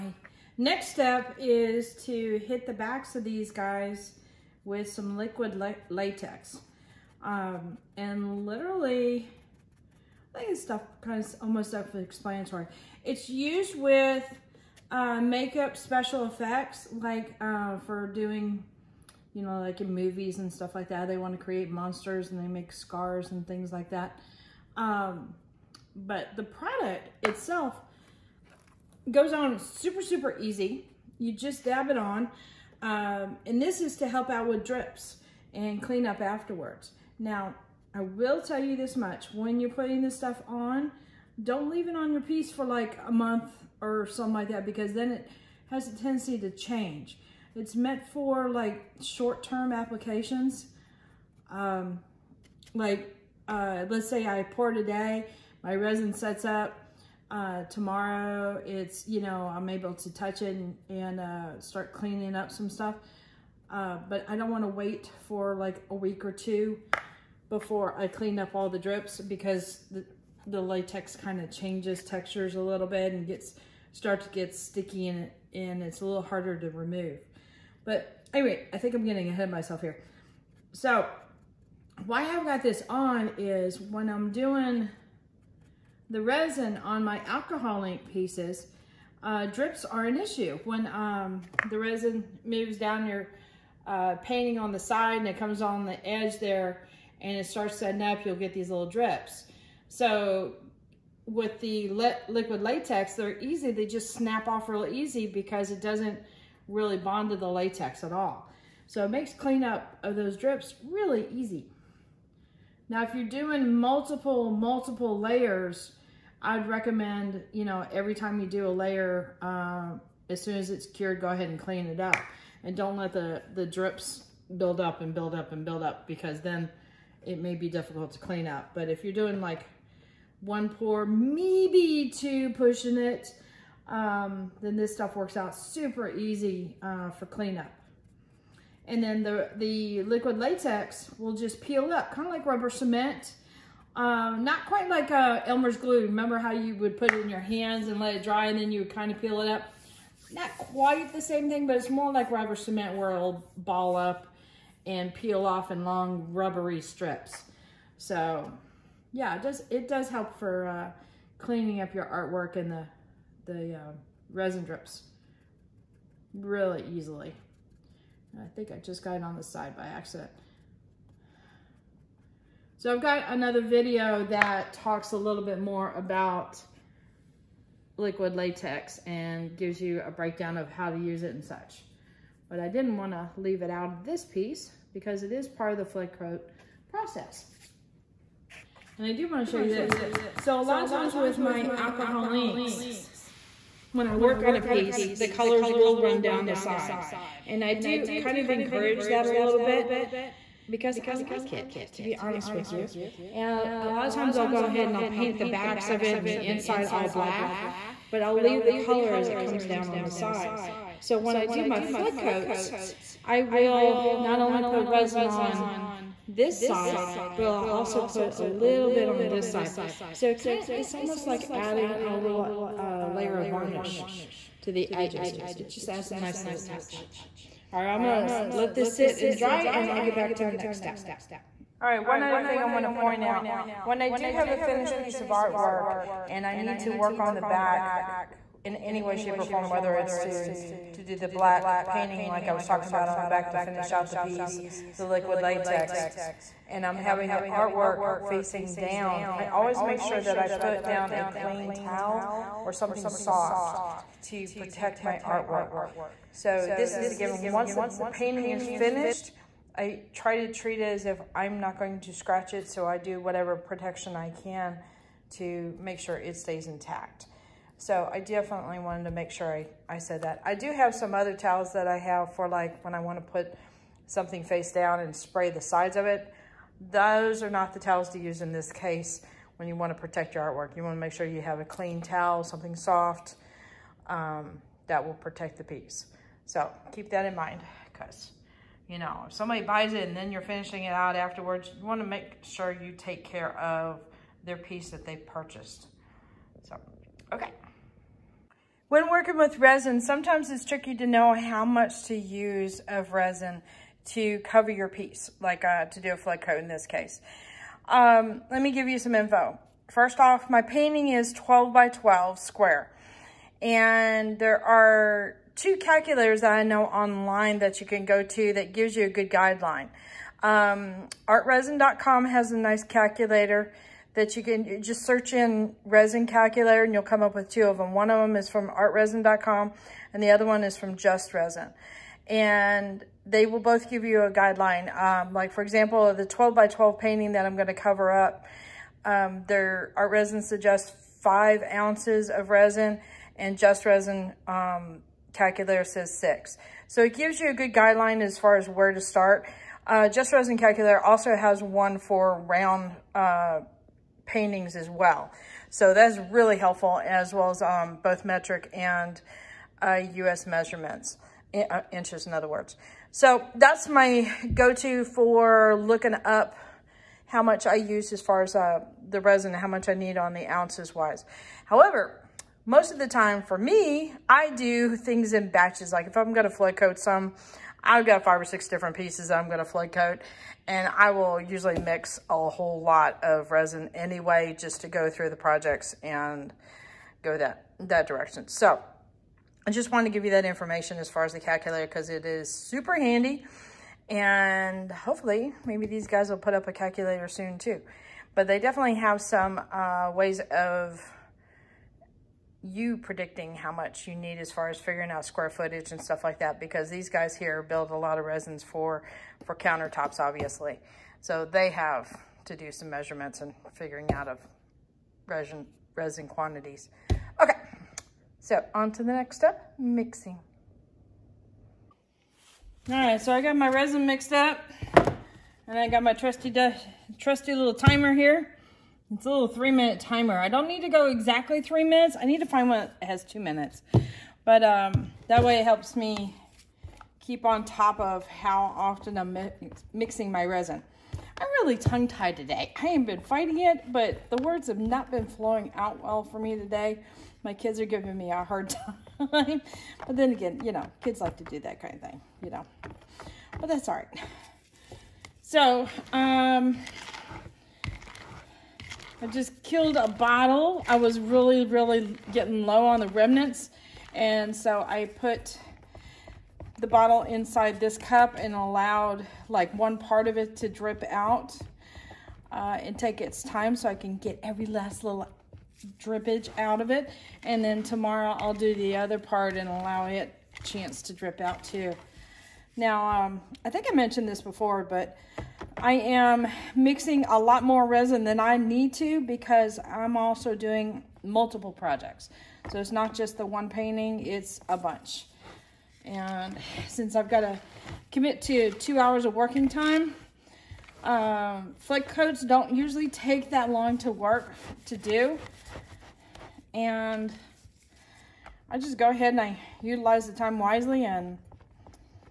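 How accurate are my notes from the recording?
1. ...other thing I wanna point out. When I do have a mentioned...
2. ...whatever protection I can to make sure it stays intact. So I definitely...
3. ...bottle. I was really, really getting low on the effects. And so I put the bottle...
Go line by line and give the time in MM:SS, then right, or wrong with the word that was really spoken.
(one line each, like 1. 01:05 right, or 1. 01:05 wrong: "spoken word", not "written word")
1. 03:52 wrong: "finished", not "mentioned"
2. 04:23 right
3. 07:40 wrong: "remnants", not "effects".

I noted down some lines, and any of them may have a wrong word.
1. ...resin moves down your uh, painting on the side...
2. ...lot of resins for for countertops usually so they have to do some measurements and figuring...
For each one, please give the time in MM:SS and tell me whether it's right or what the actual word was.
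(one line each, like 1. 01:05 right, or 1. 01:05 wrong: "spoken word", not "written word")
1. 01:31 right
2. 06:47 wrong: "obviously", not "usually".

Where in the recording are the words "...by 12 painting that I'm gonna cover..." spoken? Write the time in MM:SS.
05:36.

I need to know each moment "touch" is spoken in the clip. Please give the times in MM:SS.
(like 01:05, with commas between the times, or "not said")
01:00, 03:46.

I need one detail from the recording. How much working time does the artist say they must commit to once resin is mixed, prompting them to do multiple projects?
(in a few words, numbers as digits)
2 hours.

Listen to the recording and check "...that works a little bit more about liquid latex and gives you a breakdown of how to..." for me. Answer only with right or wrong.
wrong.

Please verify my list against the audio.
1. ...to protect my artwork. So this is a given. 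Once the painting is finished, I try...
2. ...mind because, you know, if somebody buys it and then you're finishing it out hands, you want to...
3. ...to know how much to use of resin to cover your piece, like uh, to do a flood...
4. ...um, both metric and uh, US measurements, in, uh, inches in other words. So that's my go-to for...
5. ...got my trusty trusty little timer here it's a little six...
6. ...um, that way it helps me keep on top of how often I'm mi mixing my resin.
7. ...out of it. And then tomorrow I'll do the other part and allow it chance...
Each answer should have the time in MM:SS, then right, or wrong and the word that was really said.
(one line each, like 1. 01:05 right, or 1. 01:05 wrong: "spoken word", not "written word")
1. 04:14 right
2. 04:47 wrong: "afterwards", not "hands"
3. 05:00 right
4. 05:57 right
5. 07:05 wrong: "three", not "six"
6. 07:14 right
7. 07:56 right.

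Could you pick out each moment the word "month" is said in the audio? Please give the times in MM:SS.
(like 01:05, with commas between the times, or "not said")
00:43.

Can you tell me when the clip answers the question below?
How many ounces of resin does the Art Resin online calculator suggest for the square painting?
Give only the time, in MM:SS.
05:41.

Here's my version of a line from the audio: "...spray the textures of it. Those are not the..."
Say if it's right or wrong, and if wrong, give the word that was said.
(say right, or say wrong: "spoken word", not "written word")
wrong: "sides", not "textures".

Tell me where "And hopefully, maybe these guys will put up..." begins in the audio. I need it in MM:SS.
06:34.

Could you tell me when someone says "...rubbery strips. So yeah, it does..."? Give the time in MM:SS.
02:36.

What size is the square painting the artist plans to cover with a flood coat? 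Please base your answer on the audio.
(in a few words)
12 by 12.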